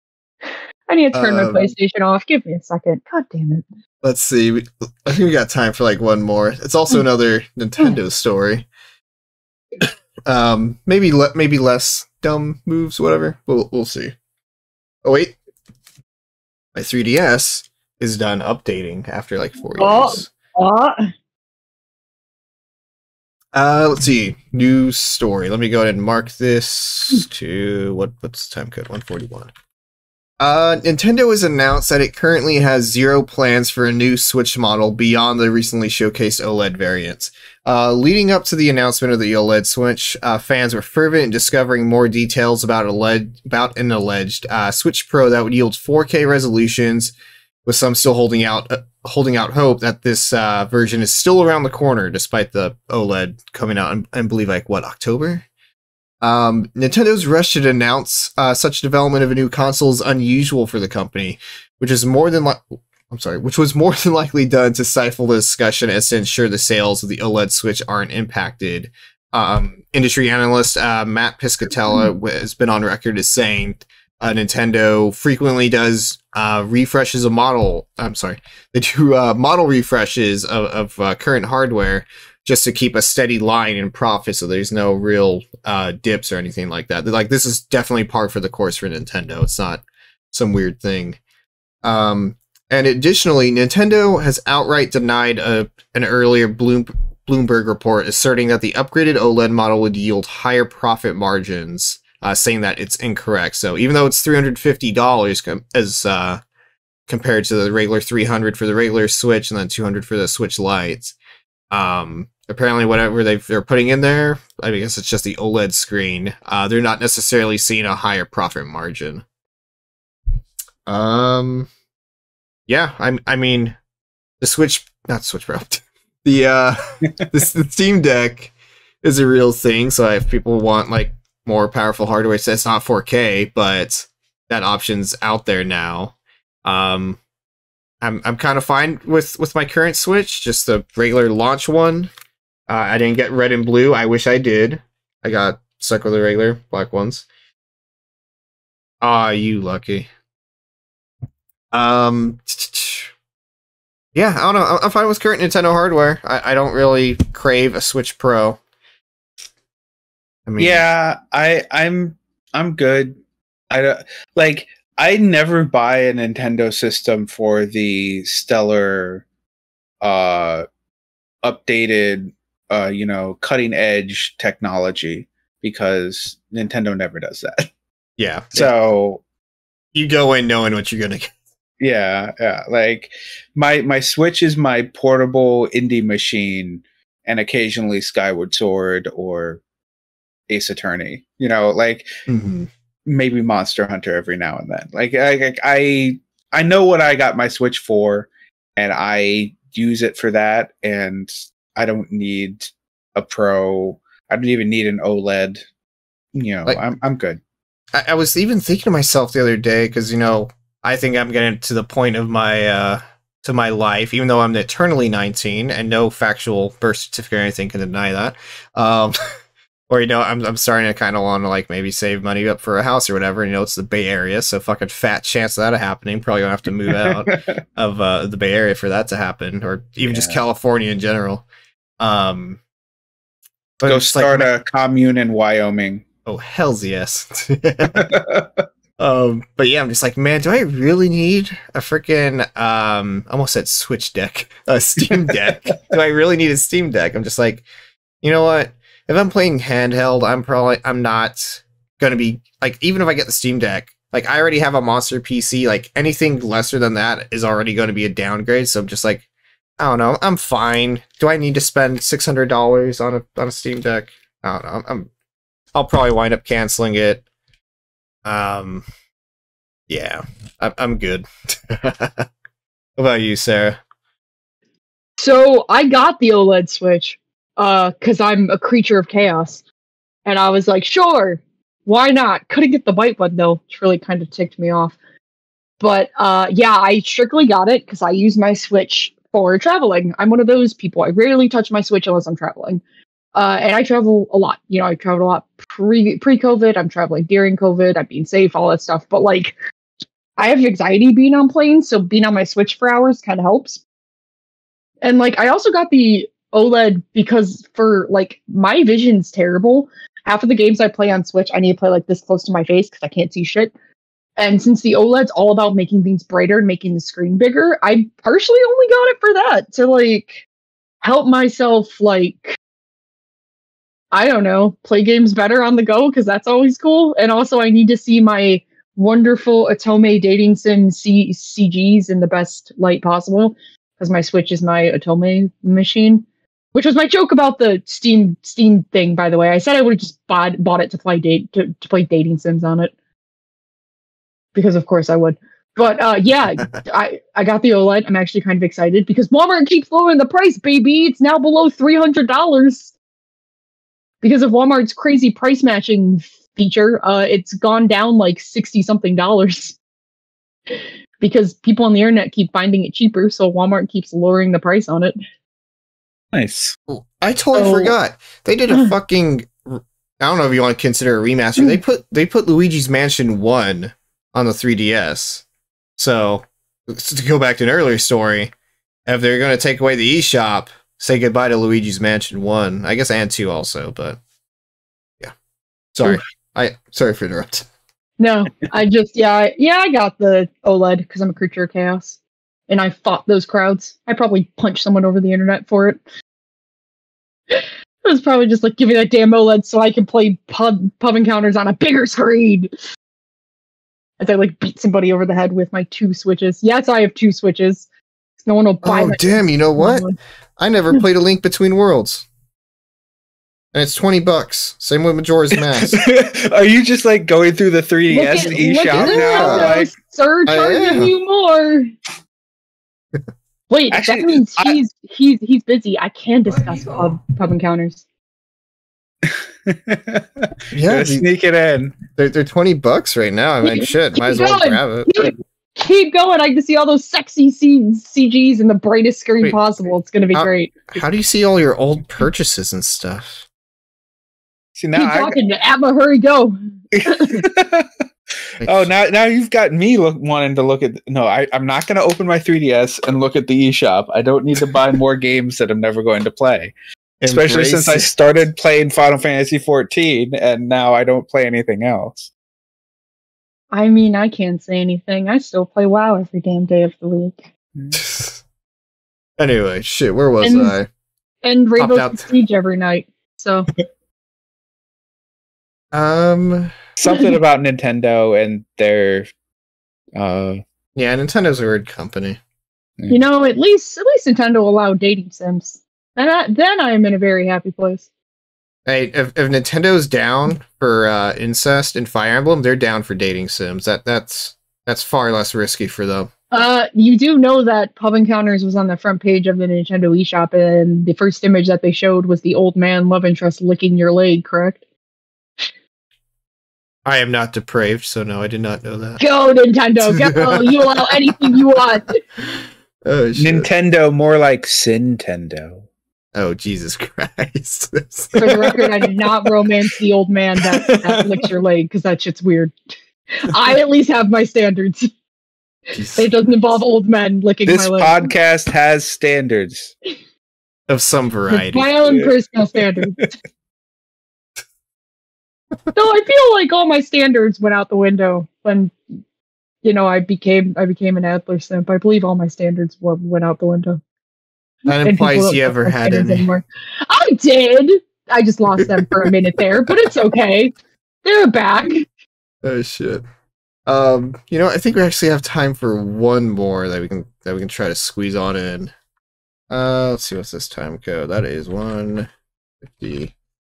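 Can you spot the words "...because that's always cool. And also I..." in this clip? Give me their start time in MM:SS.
05:26.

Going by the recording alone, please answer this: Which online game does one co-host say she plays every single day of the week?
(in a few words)
WoW.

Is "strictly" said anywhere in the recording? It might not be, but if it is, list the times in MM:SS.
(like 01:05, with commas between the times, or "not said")
04:46.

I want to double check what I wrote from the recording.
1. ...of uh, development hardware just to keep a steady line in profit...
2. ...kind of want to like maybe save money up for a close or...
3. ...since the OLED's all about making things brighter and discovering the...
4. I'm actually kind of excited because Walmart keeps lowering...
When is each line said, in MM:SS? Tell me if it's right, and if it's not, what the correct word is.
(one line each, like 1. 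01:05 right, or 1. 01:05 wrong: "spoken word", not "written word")
1. 01:20 wrong: "current", not "development"
2. 03:40 wrong: "house", not "close"
3. 05:14 wrong: "making", not "discovering"
4. 05:48 right.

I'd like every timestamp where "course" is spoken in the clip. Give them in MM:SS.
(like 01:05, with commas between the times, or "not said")
01:28, 05:44.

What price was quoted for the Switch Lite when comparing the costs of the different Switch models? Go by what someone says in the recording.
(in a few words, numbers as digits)
$200.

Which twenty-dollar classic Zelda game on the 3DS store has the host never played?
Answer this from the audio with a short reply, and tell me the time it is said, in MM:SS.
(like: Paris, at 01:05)
A Link Between Worlds, at 06:51.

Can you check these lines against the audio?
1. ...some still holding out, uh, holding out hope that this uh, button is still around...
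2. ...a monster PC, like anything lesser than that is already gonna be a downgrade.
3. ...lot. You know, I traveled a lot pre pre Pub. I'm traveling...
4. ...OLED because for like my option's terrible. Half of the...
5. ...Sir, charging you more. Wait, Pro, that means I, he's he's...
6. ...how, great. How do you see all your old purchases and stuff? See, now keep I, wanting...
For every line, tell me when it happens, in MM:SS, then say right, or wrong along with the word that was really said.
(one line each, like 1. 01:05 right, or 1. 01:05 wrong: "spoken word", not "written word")
1. 00:47 wrong: "version", not "button"
2. 04:14 right
3. 04:54 wrong: "COVID", not "Pub"
4. 05:06 wrong: "vision", not "option"
5. 07:00 wrong: "Actually", not "Pro"
6. 07:20 wrong: "talking", not "wanting".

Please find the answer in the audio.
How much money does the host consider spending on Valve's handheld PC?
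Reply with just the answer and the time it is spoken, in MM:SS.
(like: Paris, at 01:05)
$600, at 04:22.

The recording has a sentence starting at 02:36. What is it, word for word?
I, I don't really crave a Switch Pro.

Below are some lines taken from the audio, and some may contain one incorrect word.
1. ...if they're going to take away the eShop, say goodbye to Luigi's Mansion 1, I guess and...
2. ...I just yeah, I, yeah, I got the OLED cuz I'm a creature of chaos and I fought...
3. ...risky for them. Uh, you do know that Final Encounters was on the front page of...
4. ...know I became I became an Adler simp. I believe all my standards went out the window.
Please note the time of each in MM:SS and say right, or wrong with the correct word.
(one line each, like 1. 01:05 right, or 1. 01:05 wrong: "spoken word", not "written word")
1. 06:19 right
2. 06:28 right
3. 08:15 wrong: "Pub", not "Final"
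4. 08:59 right.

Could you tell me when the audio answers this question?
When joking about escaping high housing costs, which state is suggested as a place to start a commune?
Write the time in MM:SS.
03:55.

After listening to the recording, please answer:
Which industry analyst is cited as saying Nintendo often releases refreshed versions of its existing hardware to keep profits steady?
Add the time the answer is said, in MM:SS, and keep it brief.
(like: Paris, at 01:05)
Matt Piscatella, at 01:11.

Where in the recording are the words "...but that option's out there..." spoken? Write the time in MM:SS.
02:13.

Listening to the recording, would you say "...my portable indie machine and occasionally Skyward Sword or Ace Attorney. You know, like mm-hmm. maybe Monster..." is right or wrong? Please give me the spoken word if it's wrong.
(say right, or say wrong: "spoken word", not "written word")
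right.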